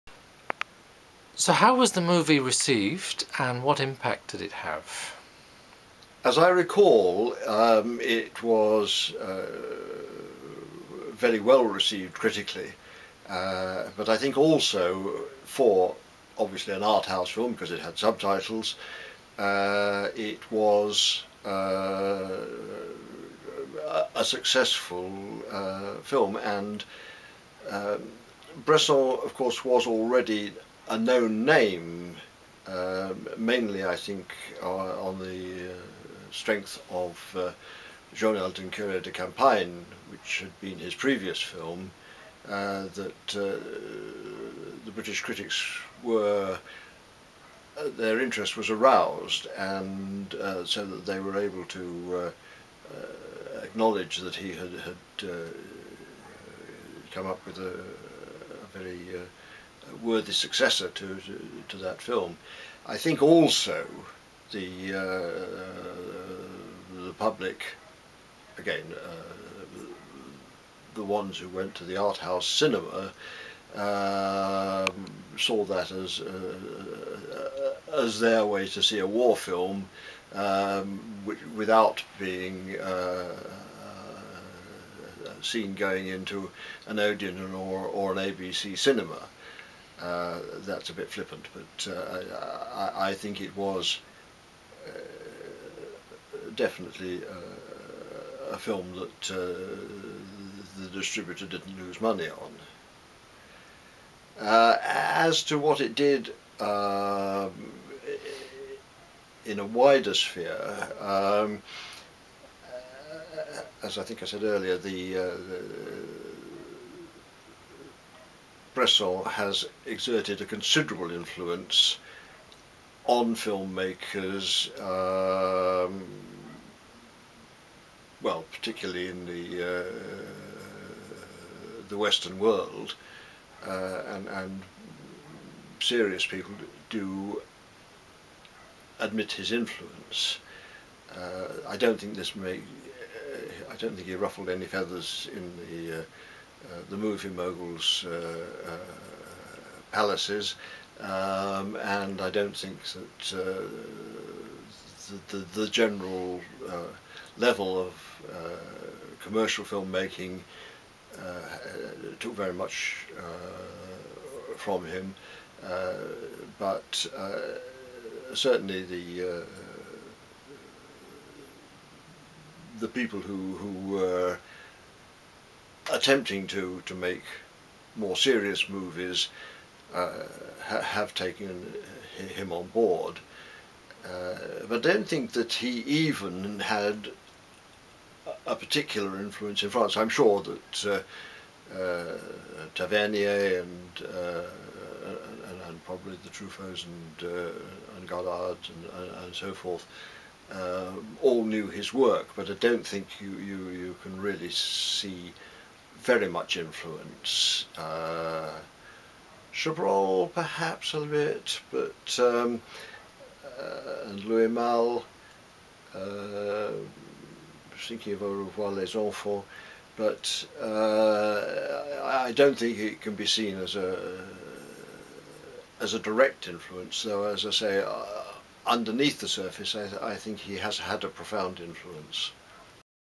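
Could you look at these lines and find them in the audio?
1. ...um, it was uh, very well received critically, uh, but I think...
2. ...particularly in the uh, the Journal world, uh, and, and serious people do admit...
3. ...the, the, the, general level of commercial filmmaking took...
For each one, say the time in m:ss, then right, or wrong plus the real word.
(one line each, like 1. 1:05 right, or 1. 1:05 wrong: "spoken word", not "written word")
1. 0:07 right
2. 2:08 wrong: "Western", not "Journal"
3. 2:35 right.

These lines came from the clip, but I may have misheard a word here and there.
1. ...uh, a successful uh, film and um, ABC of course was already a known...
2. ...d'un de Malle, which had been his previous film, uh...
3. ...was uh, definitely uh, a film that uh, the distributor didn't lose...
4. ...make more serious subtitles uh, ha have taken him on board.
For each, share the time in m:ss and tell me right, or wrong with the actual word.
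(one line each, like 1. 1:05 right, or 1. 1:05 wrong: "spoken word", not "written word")
1. 0:21 wrong: "Bresson", not "ABC"
2. 0:38 wrong: "Campagne", not "Malle"
3. 1:33 right
4. 2:56 wrong: "movies", not "subtitles".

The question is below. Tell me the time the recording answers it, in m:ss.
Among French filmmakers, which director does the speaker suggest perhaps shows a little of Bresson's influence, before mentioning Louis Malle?
3:29.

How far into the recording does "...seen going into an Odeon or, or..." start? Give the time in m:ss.
1:25.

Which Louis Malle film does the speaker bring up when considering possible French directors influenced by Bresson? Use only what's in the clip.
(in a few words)
Au revoir les enfants.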